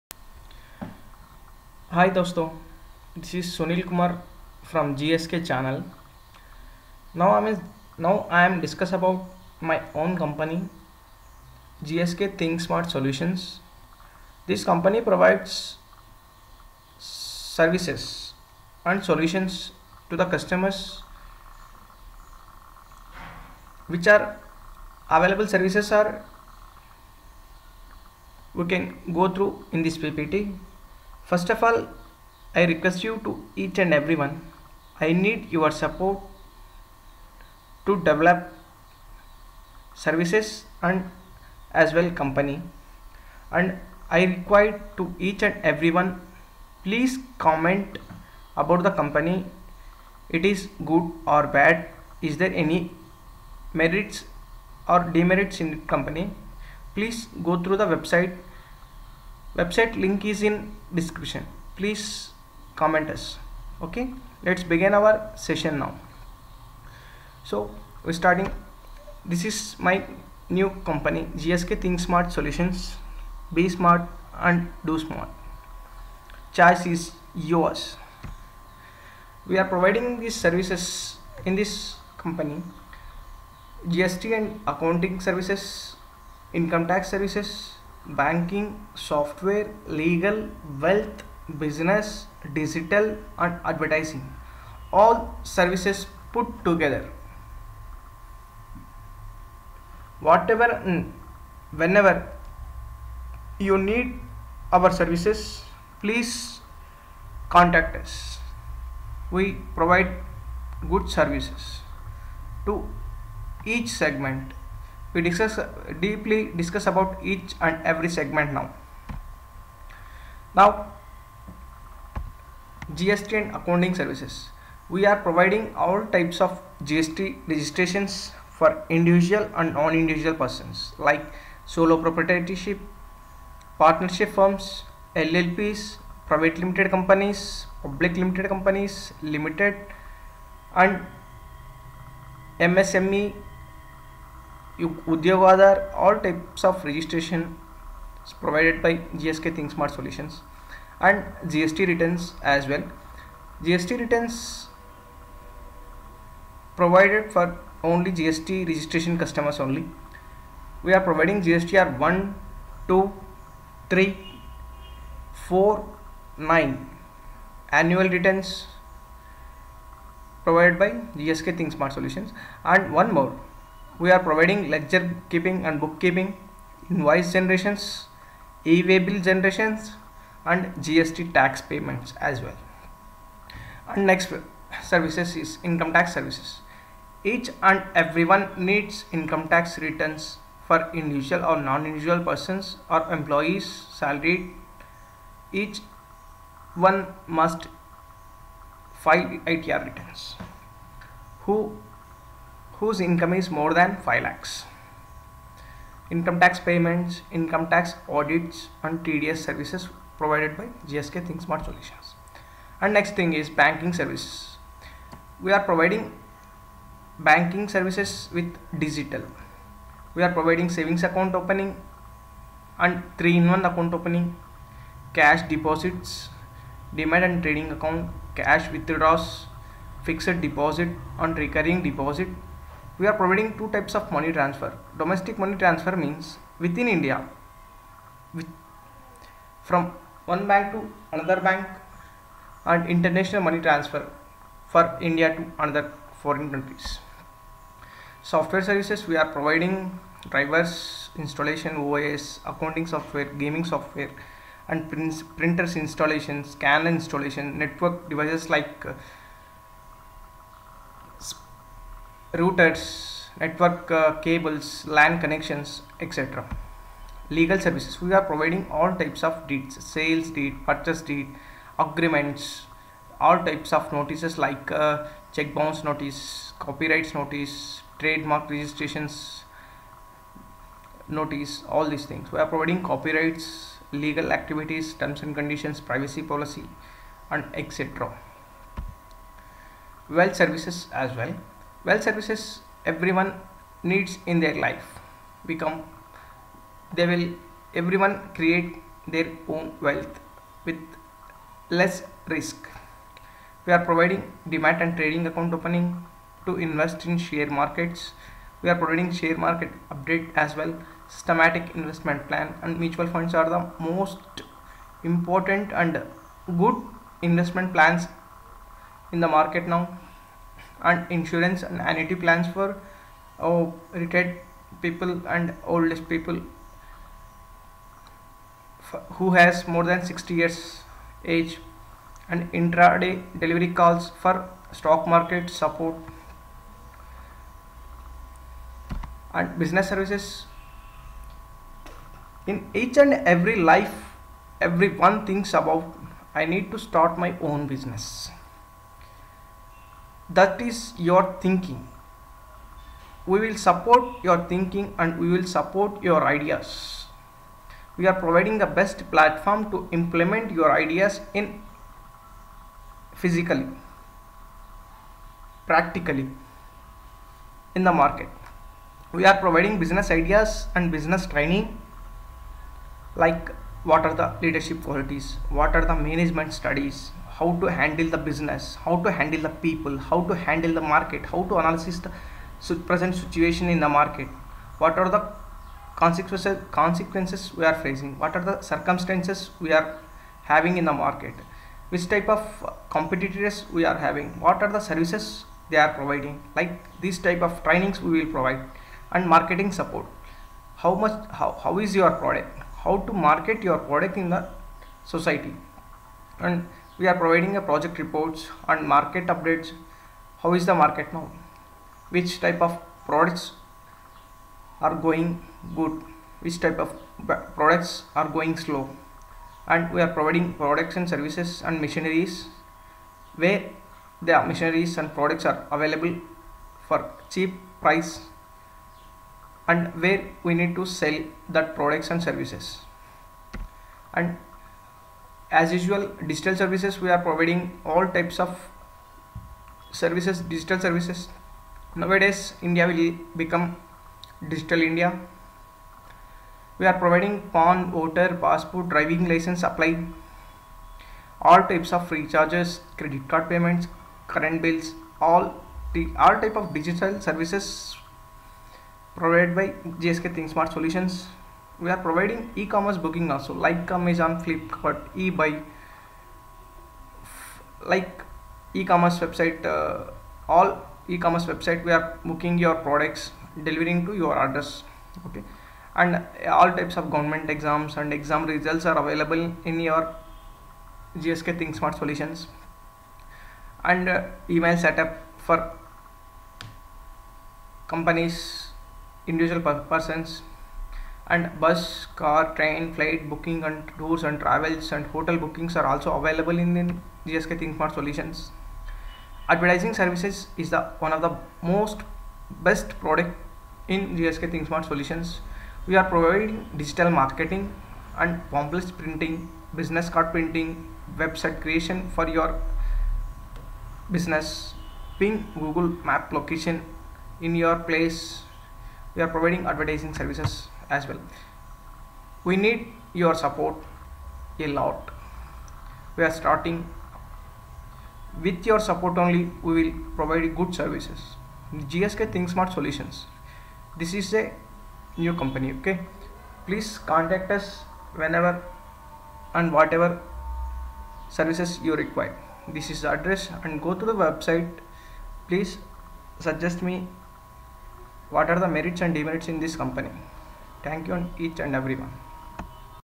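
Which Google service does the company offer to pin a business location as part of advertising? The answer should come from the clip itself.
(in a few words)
Google map.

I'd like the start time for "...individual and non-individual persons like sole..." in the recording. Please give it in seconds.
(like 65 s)
128 s.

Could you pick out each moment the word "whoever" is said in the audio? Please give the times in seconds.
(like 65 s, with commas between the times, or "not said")
not said.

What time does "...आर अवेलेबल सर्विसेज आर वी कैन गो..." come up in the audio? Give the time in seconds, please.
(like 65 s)
24 s.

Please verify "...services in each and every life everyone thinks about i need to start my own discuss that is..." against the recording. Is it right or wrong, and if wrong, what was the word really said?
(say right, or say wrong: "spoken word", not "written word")
wrong: "business", not "discuss".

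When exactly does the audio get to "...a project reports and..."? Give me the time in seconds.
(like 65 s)
407 s.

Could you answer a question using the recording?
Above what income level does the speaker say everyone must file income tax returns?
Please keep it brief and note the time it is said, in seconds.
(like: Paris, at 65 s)
5 lakhs, at 204 s.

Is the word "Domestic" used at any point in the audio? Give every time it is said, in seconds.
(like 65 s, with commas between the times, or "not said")
234 s.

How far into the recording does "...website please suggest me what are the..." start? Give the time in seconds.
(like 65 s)
544 s.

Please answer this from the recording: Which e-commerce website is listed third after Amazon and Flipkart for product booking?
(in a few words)
eBay.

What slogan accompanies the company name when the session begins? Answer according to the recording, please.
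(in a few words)
be smart and do smart.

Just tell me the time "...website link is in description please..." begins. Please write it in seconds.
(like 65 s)
59 s.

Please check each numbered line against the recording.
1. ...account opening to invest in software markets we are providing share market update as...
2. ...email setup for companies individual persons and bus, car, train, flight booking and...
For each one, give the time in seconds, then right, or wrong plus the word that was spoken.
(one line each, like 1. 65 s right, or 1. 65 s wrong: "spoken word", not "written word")
1. 305 s wrong: "share", not "software"
2. 484 s right.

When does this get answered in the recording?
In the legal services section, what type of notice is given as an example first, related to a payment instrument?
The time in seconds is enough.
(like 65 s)
275 s.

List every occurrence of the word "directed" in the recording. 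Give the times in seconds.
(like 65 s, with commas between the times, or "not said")
not said.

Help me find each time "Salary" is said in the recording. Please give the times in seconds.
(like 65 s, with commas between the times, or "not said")
193 s.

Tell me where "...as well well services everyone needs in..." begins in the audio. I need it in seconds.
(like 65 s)
290 s.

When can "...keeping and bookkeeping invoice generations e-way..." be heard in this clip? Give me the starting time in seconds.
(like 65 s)
175 s.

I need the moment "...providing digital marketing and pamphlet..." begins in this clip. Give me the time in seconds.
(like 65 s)
506 s.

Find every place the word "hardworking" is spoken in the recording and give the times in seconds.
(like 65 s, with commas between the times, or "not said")
not said.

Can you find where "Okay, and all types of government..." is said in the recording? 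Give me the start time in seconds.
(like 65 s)
475 s.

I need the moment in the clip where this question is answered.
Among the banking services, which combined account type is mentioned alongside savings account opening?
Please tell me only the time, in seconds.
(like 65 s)
223 s.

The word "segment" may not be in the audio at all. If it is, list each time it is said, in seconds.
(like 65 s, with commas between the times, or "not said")
113 s, 118 s.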